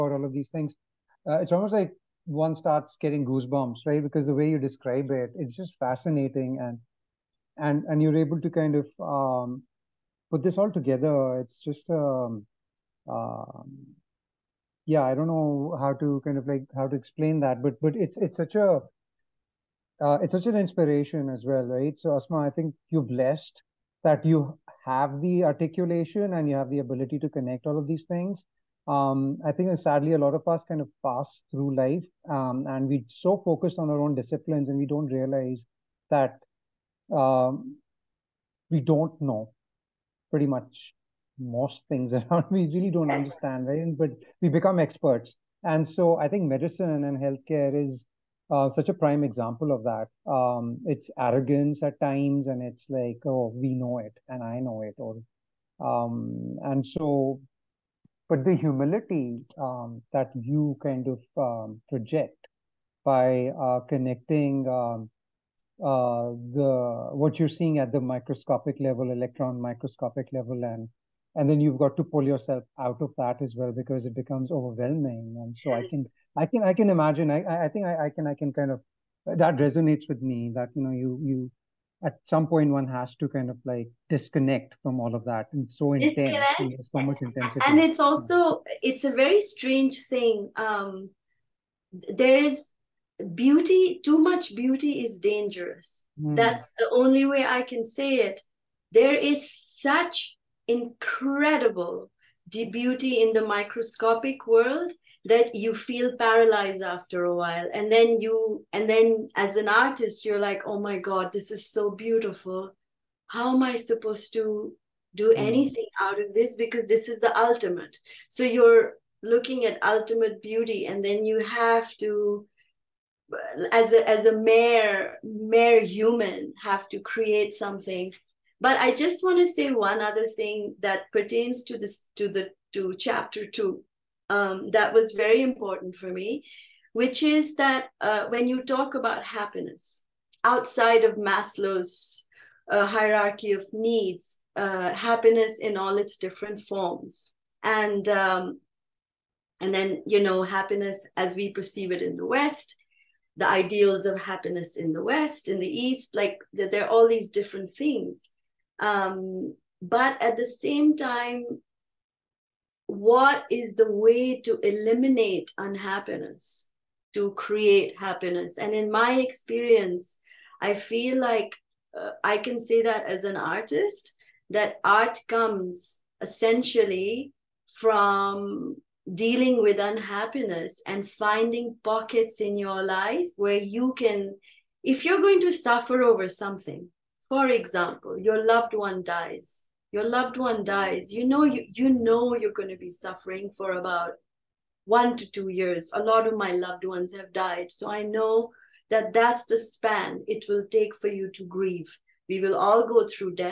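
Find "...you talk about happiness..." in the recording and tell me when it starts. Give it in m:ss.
2:18.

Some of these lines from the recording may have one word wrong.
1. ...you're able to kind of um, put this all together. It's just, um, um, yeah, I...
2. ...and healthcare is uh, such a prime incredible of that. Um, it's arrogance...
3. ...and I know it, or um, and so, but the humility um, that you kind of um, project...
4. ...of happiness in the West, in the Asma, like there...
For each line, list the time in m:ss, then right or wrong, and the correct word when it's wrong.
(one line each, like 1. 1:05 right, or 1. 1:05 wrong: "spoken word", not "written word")
1. 0:08 right
2. 0:47 wrong: "example", not "incredible"
3. 0:54 right
4. 2:34 wrong: "East", not "Asma".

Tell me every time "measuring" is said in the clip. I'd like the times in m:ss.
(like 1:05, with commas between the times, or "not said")
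not said.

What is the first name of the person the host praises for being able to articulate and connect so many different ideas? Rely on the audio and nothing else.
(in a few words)
Asma.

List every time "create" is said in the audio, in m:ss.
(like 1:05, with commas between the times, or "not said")
2:06, 2:47.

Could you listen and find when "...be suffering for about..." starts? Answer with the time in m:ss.
3:12.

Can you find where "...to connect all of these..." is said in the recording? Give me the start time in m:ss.
0:27.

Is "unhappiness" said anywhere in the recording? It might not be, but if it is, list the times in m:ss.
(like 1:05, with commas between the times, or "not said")
2:45, 2:59.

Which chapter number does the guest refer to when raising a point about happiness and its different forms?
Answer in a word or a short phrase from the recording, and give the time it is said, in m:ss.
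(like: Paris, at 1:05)
2, at 2:13.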